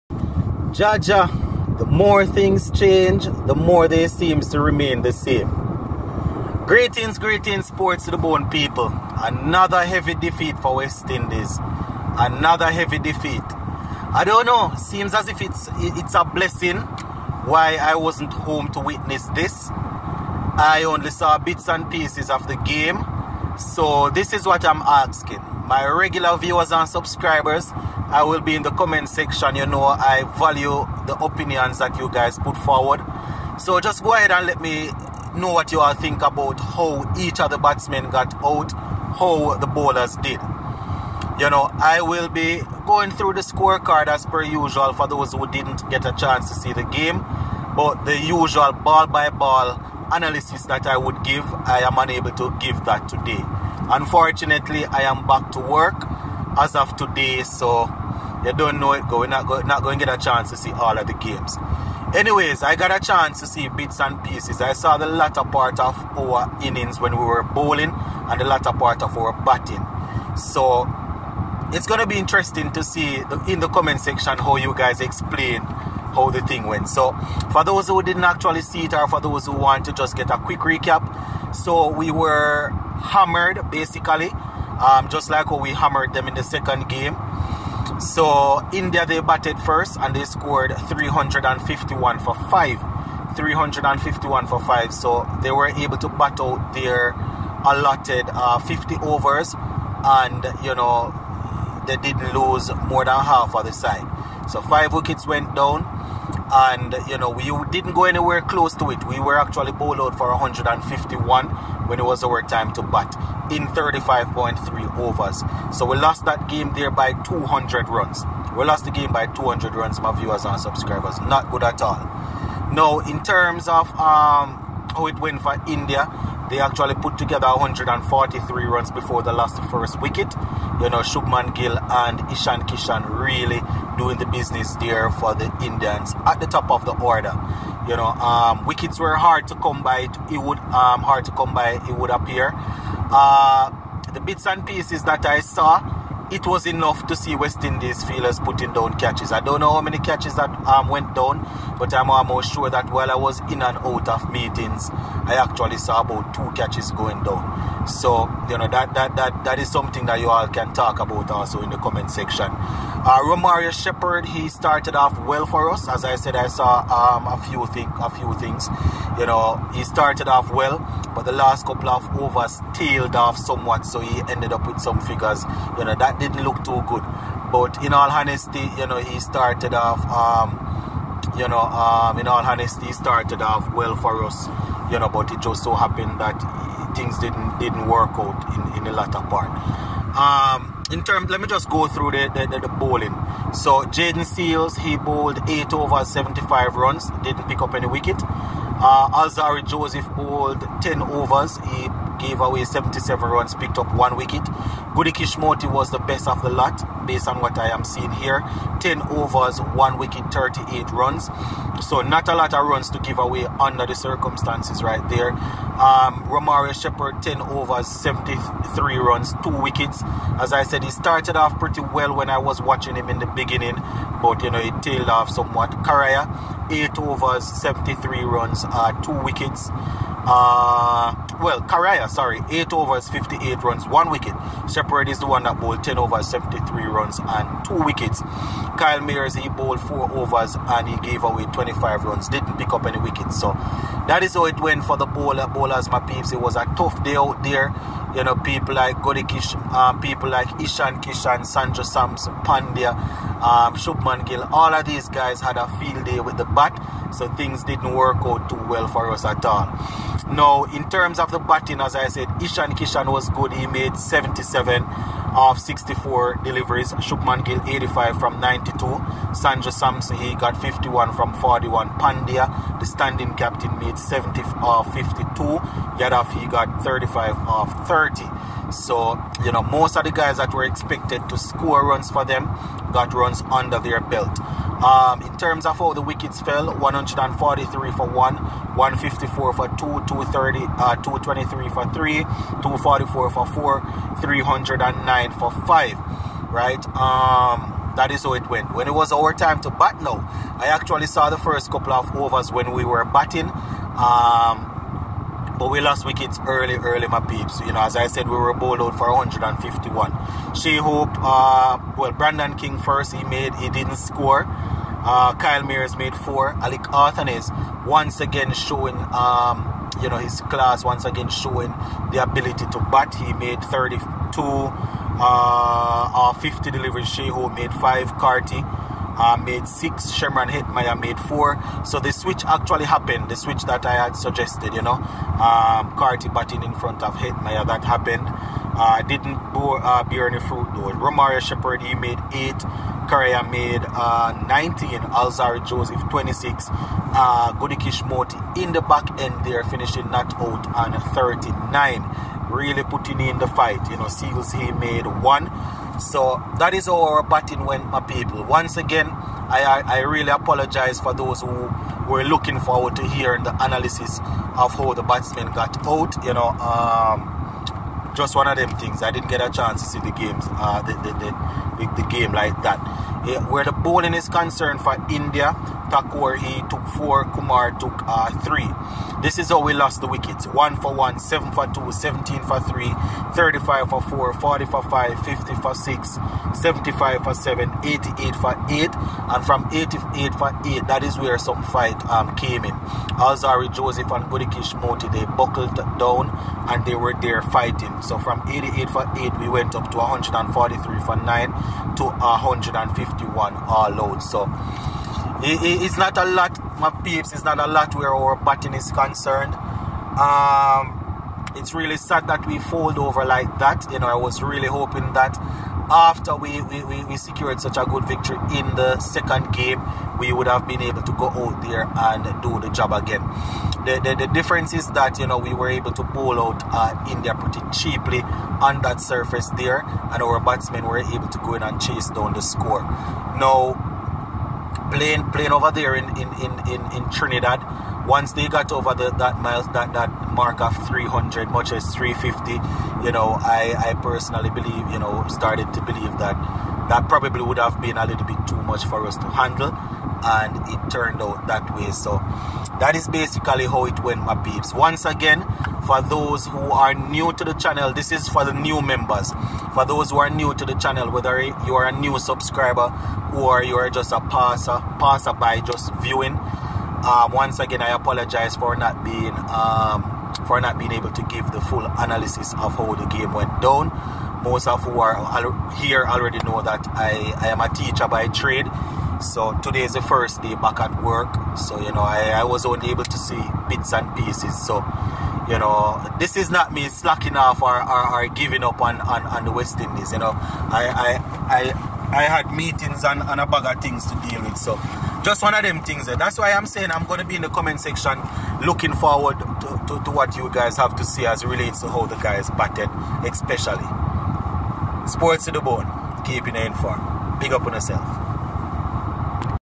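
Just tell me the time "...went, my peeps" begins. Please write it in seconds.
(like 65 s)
454 s.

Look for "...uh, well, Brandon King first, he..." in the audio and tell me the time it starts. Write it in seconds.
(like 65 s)
311 s.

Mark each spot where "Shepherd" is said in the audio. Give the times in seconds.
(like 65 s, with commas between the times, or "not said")
163 s, 216 s, 341 s.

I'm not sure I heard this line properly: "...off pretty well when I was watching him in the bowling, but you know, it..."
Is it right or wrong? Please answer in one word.
wrong.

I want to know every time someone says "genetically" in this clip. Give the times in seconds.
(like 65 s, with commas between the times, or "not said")
not said.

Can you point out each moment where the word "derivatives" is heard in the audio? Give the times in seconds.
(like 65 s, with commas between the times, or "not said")
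not said.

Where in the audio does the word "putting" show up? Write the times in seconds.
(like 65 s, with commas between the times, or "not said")
148 s, 352 s.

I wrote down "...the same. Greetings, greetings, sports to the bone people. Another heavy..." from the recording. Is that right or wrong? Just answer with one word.
right.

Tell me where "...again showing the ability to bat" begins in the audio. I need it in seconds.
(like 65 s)
321 s.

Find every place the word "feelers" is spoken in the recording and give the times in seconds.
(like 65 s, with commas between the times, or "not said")
148 s.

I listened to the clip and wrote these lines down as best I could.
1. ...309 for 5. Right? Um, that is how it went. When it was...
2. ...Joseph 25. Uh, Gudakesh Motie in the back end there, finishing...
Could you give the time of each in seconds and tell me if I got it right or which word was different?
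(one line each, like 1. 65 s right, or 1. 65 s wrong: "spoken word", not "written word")
1. 294 s right
2. 345 s wrong: "26", not "25".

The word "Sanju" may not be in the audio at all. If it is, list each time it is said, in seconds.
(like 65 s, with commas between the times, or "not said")
251 s, 269 s.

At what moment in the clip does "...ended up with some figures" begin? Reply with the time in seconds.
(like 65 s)
174 s.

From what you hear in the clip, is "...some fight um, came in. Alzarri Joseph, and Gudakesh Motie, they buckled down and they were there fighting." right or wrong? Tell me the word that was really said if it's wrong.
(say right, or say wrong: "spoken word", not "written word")
right.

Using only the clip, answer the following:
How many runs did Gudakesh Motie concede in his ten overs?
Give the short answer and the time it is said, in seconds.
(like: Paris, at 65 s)
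38, at 210 s.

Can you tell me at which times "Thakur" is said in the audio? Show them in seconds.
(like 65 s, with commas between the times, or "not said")
375 s.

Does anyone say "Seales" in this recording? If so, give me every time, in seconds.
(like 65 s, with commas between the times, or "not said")
194 s, 354 s.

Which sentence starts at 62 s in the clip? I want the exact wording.
Anyways, I got a chance to see bits and pieces.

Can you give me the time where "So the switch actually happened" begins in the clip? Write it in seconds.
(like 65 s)
331 s.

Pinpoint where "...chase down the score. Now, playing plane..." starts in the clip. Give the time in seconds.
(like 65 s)
431 s.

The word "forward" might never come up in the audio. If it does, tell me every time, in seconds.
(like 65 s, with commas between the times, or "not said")
32 s, 362 s, 498 s.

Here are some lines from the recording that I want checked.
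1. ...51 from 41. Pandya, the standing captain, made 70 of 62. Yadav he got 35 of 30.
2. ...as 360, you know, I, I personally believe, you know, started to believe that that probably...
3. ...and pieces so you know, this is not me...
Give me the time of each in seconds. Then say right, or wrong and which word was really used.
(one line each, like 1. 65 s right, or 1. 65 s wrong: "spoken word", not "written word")
1. 270 s wrong: "52", not "62"
2. 441 s wrong: "350", not "360"
3. 483 s right.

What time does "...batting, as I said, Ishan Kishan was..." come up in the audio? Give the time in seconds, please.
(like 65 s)
261 s.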